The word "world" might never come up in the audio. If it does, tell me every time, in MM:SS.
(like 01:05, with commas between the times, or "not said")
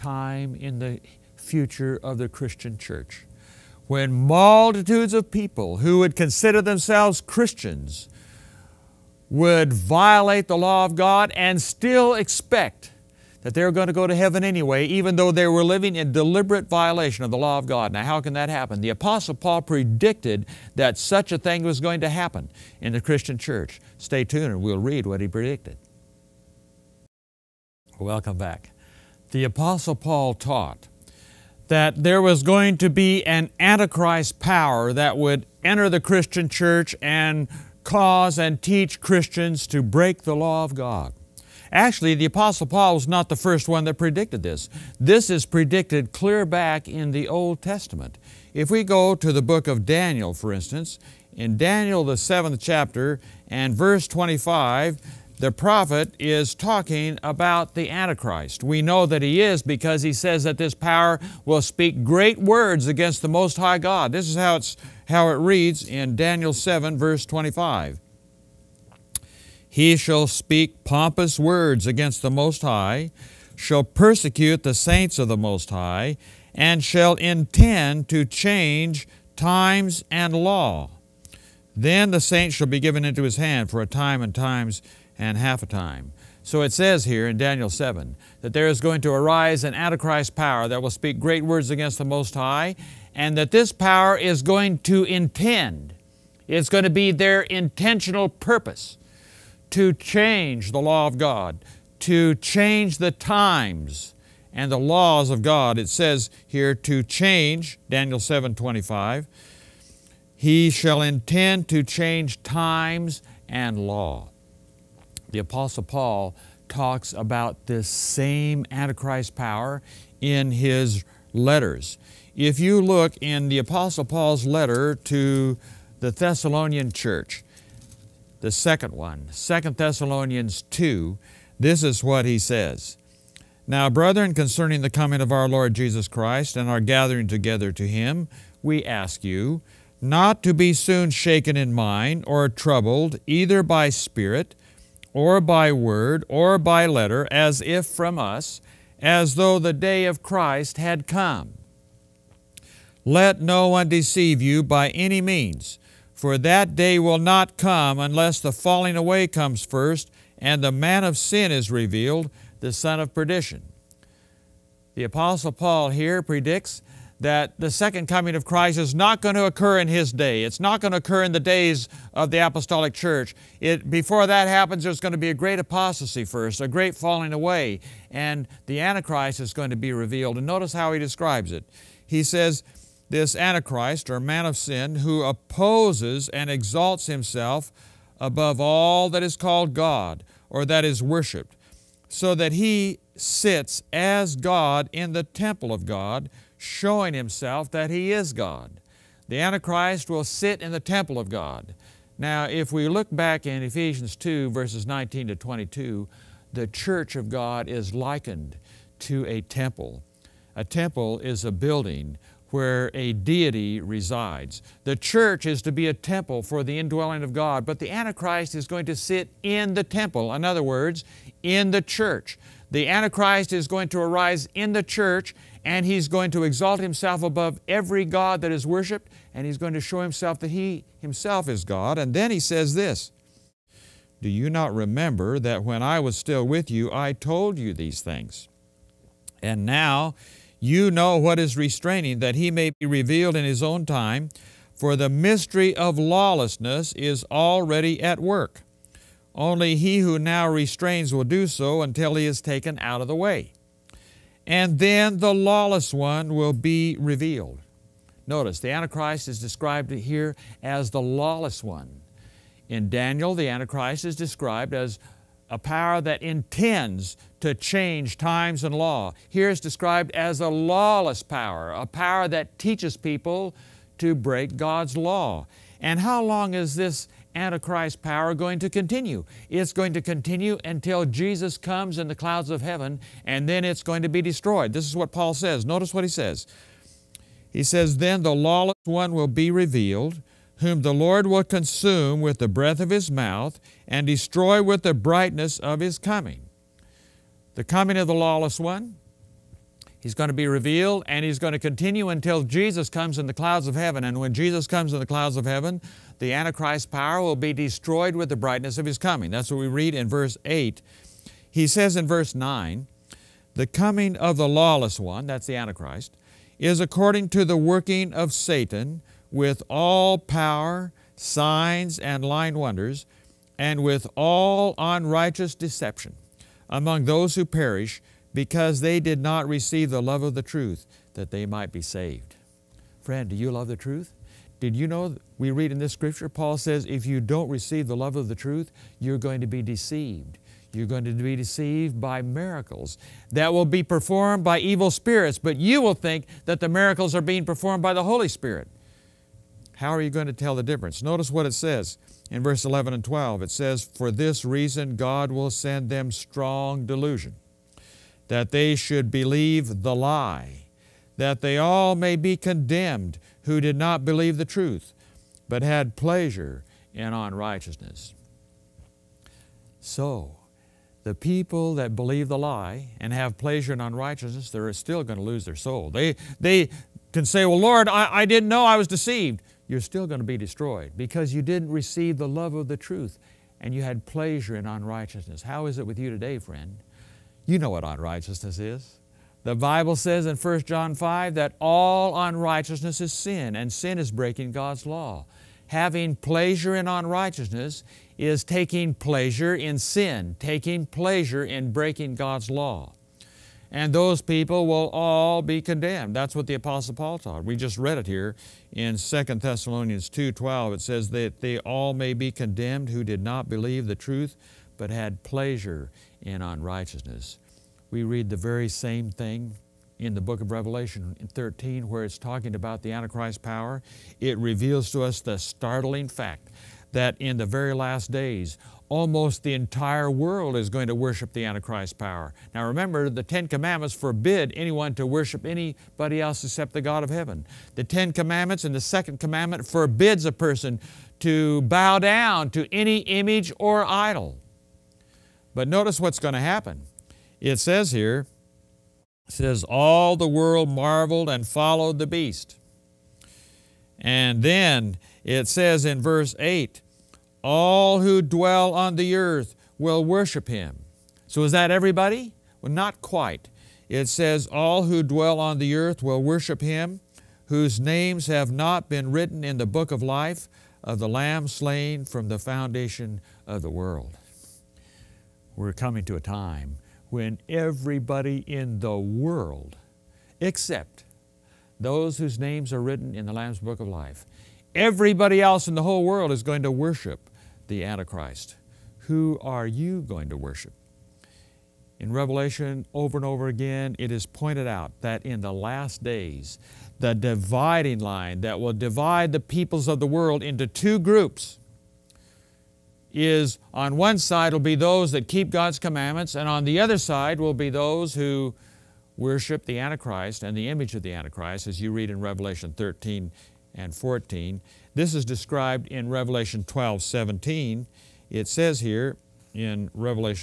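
07:10, 07:30, 07:53, 07:58, 08:06, 08:20.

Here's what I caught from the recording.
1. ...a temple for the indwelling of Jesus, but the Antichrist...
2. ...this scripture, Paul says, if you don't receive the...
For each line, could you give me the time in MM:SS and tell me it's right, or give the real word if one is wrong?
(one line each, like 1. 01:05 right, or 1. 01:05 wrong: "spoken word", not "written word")
1. 03:35 wrong: "God", not "Jesus"
2. 05:35 right.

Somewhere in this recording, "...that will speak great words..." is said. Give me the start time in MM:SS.
01:30.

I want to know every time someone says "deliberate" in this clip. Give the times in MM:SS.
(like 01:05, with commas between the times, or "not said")
00:16.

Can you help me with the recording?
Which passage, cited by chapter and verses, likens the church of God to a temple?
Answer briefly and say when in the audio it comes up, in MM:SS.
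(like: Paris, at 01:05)
Ephesians 2:19-22, at 03:23.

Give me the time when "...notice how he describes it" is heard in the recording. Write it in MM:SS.
03:00.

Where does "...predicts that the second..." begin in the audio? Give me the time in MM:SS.
02:46.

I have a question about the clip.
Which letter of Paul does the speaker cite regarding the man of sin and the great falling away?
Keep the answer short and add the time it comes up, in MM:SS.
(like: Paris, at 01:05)
Second Thessalonians 2, at 02:09.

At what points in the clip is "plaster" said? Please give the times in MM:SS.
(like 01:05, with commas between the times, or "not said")
not said.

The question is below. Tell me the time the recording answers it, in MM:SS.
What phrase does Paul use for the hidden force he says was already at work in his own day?
04:04.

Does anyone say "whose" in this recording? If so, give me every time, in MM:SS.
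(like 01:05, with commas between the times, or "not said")
07:47, 08:02.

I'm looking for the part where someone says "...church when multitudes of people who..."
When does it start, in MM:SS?
00:02.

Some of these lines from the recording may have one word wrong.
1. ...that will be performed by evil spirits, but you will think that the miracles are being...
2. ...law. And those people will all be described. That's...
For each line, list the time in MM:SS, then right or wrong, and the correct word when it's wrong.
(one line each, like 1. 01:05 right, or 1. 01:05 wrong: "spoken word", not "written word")
1. 05:43 right
2. 06:42 wrong: "condemned", not "described".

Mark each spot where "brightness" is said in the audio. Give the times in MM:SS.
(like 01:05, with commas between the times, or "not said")
04:54, 05:08.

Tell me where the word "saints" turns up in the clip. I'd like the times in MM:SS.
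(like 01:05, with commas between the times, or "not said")
01:14, 01:22.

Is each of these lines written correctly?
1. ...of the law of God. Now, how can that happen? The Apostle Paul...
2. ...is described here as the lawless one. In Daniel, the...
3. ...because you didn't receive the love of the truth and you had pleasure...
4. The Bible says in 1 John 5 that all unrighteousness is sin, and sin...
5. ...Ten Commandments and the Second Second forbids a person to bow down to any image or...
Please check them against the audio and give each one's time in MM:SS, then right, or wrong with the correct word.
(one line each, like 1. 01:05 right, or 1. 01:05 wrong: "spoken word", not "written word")
1. 00:17 right
2. 04:19 right
3. 06:20 right
4. 06:29 right
5. 07:17 wrong: "Commandment", not "Second".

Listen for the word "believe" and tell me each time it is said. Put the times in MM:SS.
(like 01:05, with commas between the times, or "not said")
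05:59, 06:04, 06:11, 06:53.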